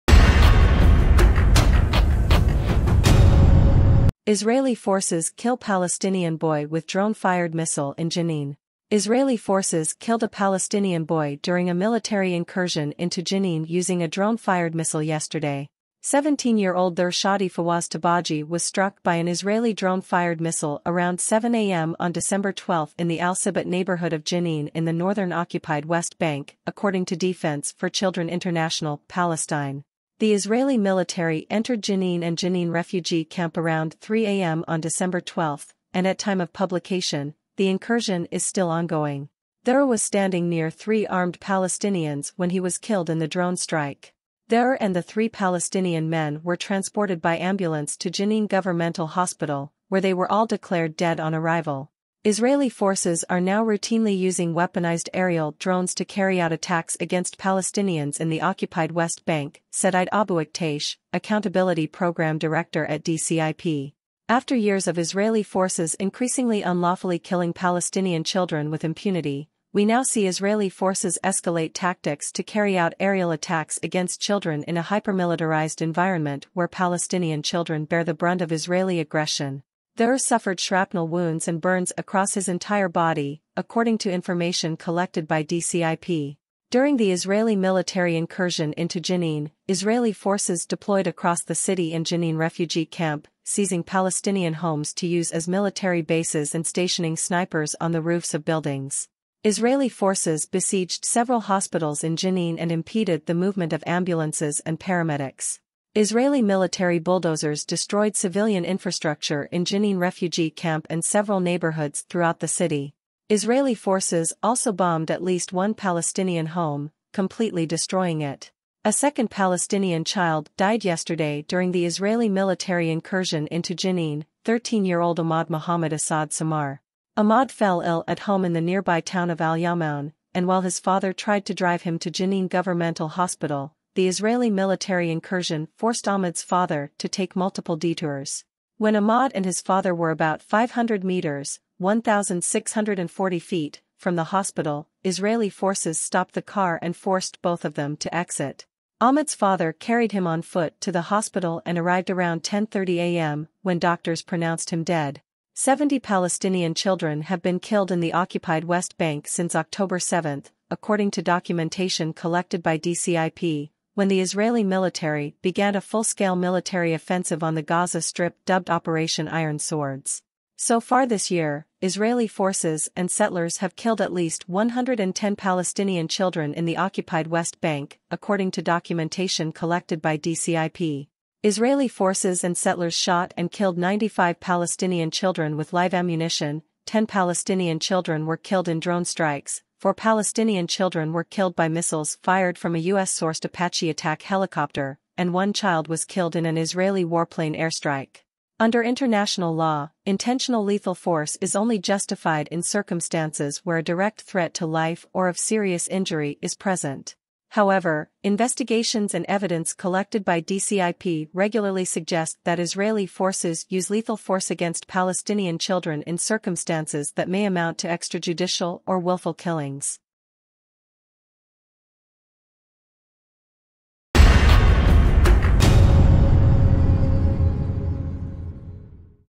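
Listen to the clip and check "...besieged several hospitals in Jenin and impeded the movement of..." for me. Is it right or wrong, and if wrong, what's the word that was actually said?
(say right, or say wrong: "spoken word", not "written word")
right.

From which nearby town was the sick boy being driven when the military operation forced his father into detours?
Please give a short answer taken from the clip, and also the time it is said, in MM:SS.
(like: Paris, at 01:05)
Al Yamoun, at 02:09.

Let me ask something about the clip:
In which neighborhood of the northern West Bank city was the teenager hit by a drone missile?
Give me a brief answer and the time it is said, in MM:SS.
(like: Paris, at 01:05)
Al-Sibat, at 00:23.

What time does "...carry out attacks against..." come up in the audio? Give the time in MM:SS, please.
00:56.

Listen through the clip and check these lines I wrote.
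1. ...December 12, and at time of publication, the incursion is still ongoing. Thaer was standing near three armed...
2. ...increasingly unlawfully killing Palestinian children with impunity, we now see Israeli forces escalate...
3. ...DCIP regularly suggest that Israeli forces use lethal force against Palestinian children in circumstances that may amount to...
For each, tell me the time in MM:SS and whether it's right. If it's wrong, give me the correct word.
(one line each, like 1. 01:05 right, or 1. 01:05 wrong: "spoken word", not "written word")
1. 00:34 right
2. 01:05 right
3. 03:30 right.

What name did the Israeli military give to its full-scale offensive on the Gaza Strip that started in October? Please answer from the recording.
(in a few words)
Operation Iron Swords.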